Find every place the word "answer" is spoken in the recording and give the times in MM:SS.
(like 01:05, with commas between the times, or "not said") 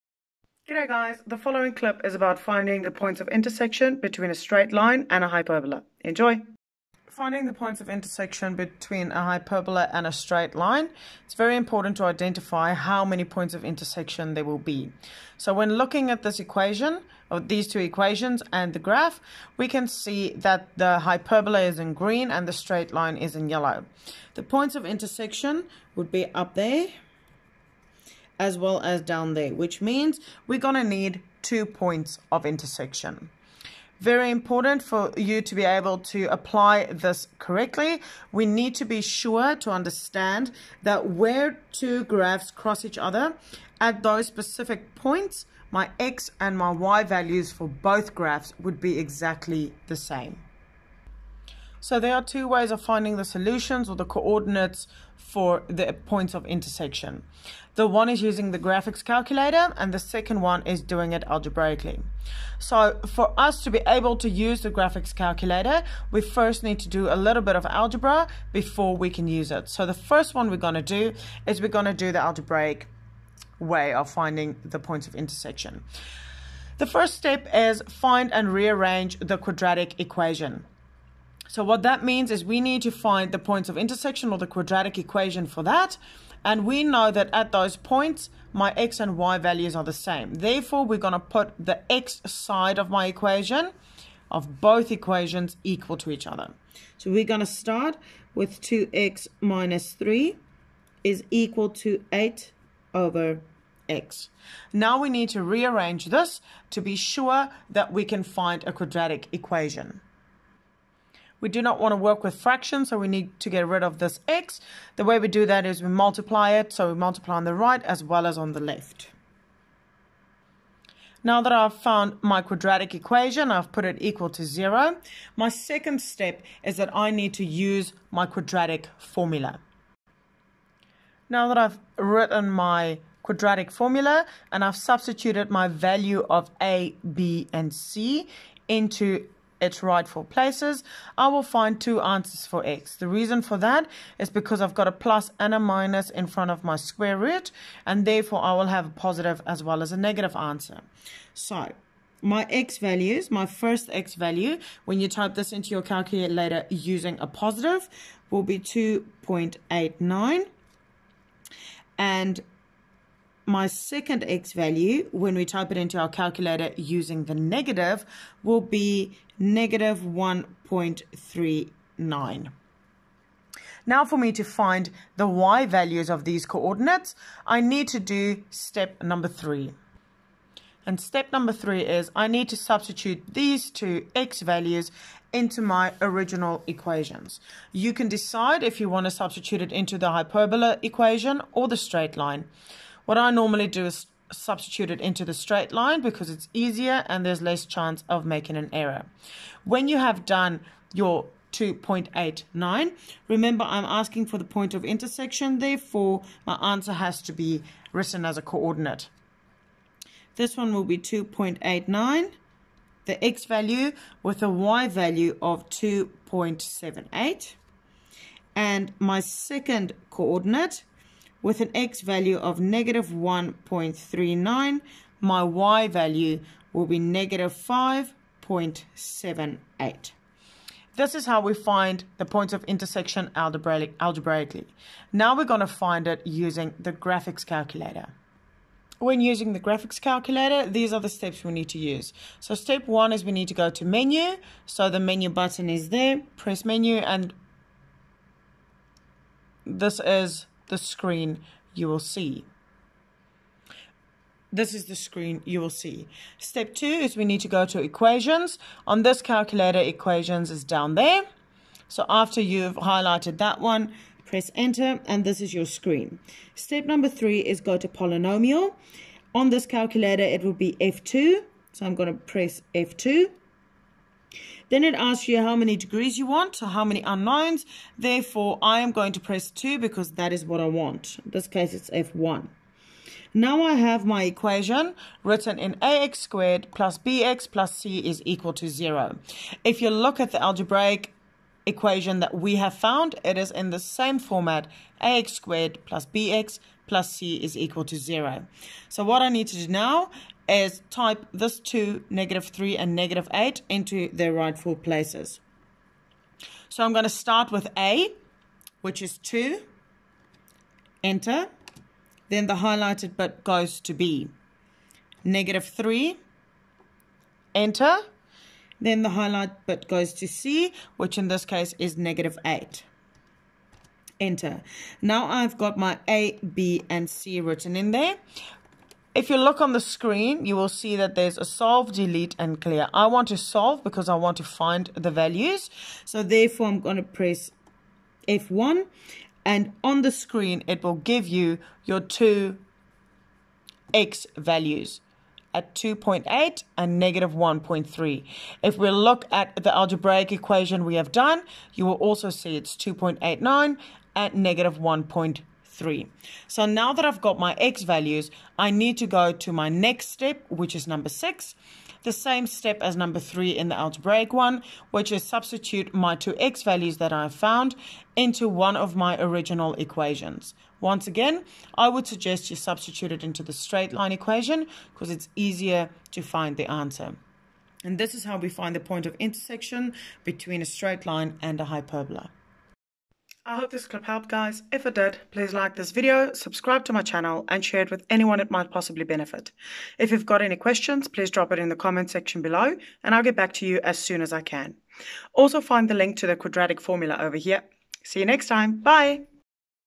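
02:22, 02:30, 03:26, 06:16.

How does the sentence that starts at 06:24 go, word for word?
If it did, please like this video, subscribe to my channel and share it with anyone it might possibly benefit.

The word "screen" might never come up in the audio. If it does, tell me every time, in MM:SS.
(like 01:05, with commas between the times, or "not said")
04:10, 04:14, 04:25, 05:29, 05:40.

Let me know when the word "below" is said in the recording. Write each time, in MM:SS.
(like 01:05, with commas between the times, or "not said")
06:32.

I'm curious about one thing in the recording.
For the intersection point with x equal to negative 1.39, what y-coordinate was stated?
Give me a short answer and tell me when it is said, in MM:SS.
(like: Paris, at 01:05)
-5.78, at 03:46.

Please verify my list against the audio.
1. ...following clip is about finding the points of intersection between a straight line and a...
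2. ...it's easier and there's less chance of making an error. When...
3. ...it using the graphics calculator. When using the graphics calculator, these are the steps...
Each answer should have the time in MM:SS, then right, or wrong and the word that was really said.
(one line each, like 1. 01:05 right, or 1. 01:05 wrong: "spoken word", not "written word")
1. 00:01 right
2. 03:16 right
3. 03:56 right.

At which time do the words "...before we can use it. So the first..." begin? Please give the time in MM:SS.
01:08.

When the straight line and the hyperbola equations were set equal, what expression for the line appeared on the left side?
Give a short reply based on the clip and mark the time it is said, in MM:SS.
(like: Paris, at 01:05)
2x - 3, at 01:38.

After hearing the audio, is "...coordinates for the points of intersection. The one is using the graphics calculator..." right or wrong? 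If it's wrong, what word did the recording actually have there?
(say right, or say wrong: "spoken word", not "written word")
right.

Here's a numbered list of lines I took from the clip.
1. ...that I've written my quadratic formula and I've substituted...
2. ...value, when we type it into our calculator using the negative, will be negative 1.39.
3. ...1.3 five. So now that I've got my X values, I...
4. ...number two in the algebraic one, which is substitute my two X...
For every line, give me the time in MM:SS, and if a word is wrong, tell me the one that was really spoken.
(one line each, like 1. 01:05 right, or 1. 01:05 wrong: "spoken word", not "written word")
1. 02:11 right
2. 02:44 right
3. 05:54 wrong: "three", not "five"
4. 06:02 wrong: "three", not "two".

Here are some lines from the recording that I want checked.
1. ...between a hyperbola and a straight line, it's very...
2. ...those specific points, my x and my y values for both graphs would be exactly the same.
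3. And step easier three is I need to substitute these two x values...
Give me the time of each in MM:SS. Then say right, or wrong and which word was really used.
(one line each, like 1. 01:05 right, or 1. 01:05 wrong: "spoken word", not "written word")
1. 00:08 right
2. 00:44 right
3. 03:00 wrong: "number", not "easier".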